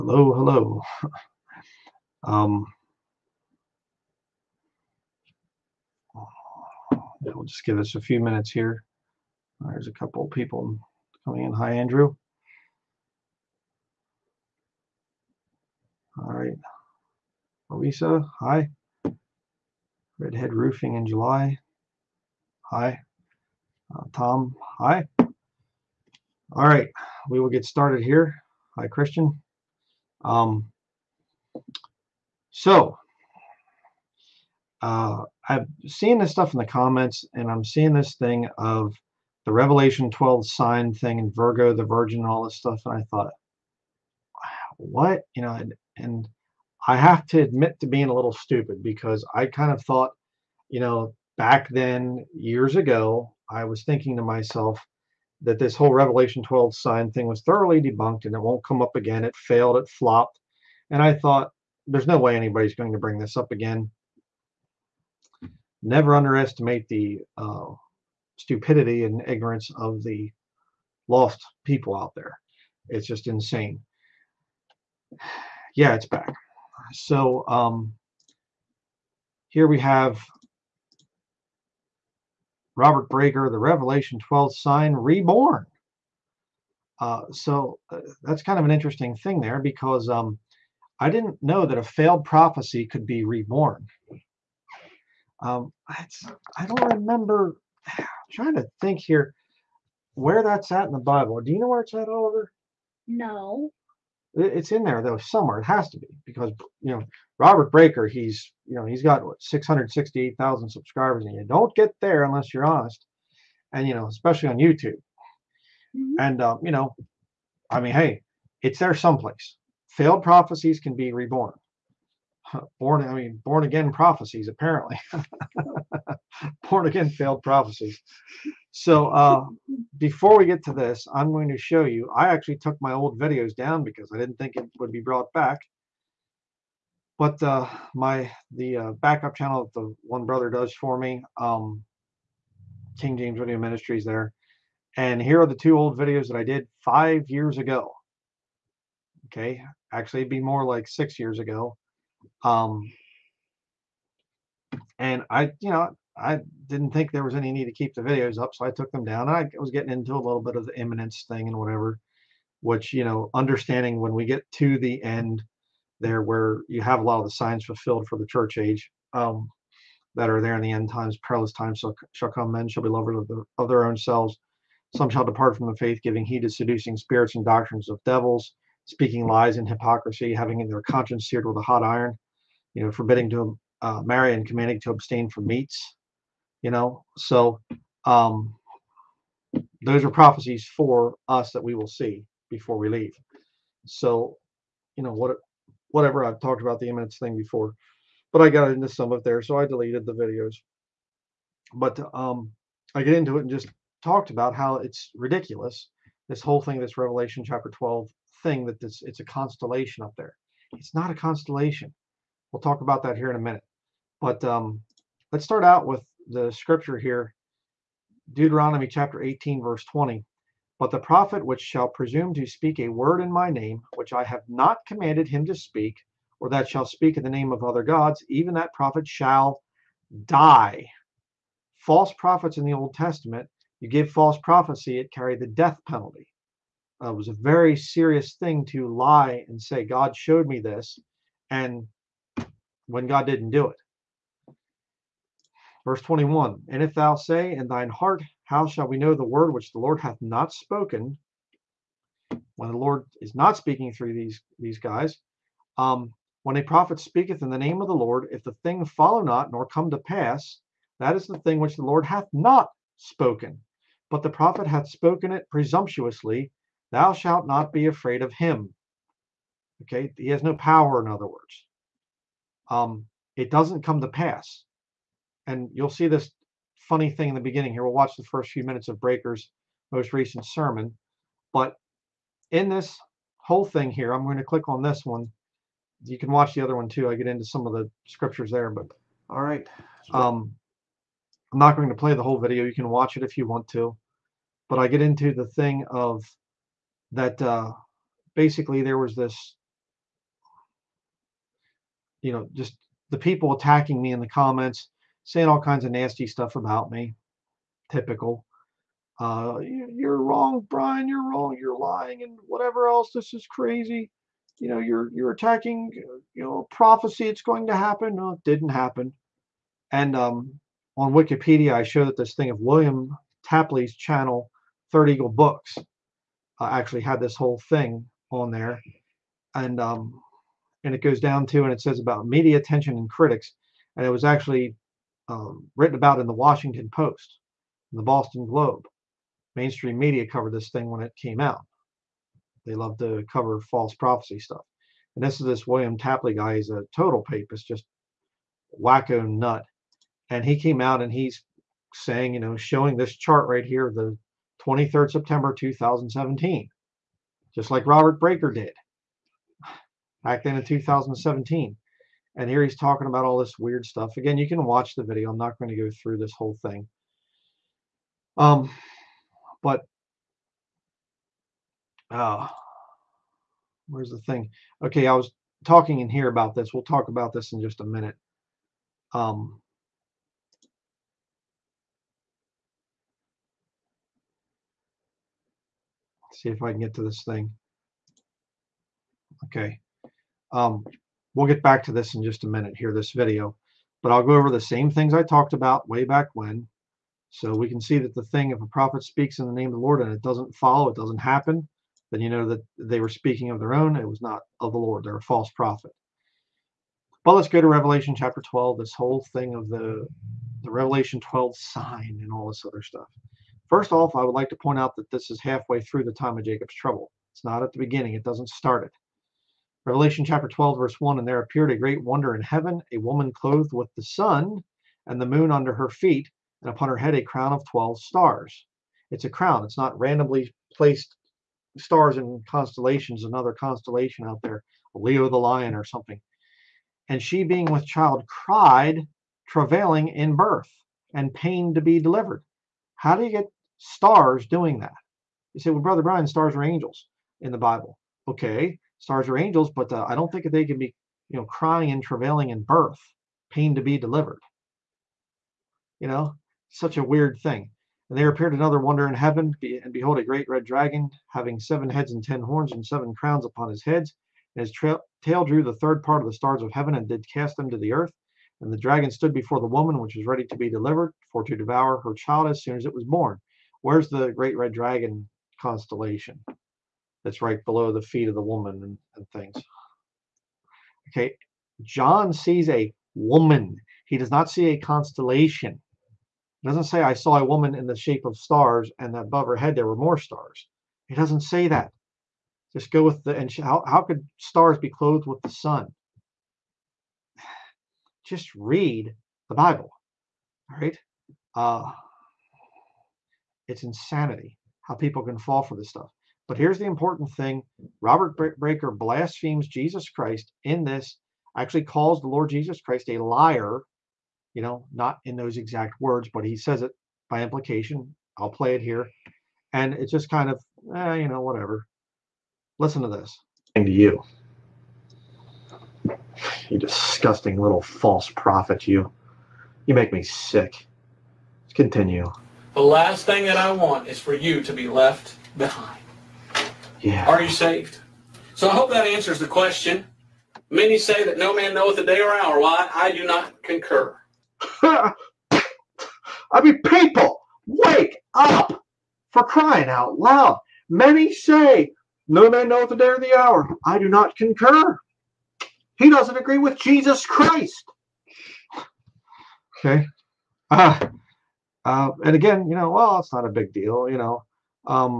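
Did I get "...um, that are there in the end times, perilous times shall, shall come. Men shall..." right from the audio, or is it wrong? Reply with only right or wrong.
right.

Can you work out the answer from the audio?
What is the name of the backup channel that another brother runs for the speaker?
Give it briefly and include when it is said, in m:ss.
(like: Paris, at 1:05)
King James Video Ministries, at 2:22.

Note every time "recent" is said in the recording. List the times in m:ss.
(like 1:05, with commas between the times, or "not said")
4:40.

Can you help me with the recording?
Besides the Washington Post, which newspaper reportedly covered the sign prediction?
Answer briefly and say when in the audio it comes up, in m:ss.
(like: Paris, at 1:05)
Boston Globe, at 5:37.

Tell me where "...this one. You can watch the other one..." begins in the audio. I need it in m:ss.
4:44.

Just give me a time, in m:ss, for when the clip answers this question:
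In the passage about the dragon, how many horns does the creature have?
7:42.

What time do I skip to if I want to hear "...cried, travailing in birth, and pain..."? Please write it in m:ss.
7:18.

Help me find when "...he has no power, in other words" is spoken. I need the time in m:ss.
4:30.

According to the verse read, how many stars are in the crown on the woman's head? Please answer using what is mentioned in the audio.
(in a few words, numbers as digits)
12.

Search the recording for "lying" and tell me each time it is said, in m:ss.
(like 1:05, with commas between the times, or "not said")
5:11.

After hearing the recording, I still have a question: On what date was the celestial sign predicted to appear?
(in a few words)
23 September 2017.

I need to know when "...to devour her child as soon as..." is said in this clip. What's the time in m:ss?
7:51.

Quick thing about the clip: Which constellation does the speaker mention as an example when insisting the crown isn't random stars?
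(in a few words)
Leo.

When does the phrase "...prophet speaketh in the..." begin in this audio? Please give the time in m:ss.
4:16.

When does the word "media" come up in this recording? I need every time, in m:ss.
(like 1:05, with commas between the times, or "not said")
5:32, 5:39.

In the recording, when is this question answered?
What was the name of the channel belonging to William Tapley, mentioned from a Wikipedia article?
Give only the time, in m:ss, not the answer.
5:24.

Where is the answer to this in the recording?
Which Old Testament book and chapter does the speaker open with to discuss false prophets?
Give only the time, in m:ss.
3:38.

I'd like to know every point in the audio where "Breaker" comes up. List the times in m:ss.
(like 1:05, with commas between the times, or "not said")
1:23, 1:47, 4:38, 5:58, 8:28.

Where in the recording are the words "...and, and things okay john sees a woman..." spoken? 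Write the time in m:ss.
7:58.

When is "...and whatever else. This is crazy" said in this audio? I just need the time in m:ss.
5:12.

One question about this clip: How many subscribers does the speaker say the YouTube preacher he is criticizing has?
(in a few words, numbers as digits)
668,000.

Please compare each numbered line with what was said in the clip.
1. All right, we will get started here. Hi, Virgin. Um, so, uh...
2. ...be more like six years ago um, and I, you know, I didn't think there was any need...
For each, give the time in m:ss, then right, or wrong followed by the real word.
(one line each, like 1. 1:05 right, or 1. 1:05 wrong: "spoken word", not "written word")
1. 0:26 wrong: "Christian", not "Virgin"
2. 2:30 right.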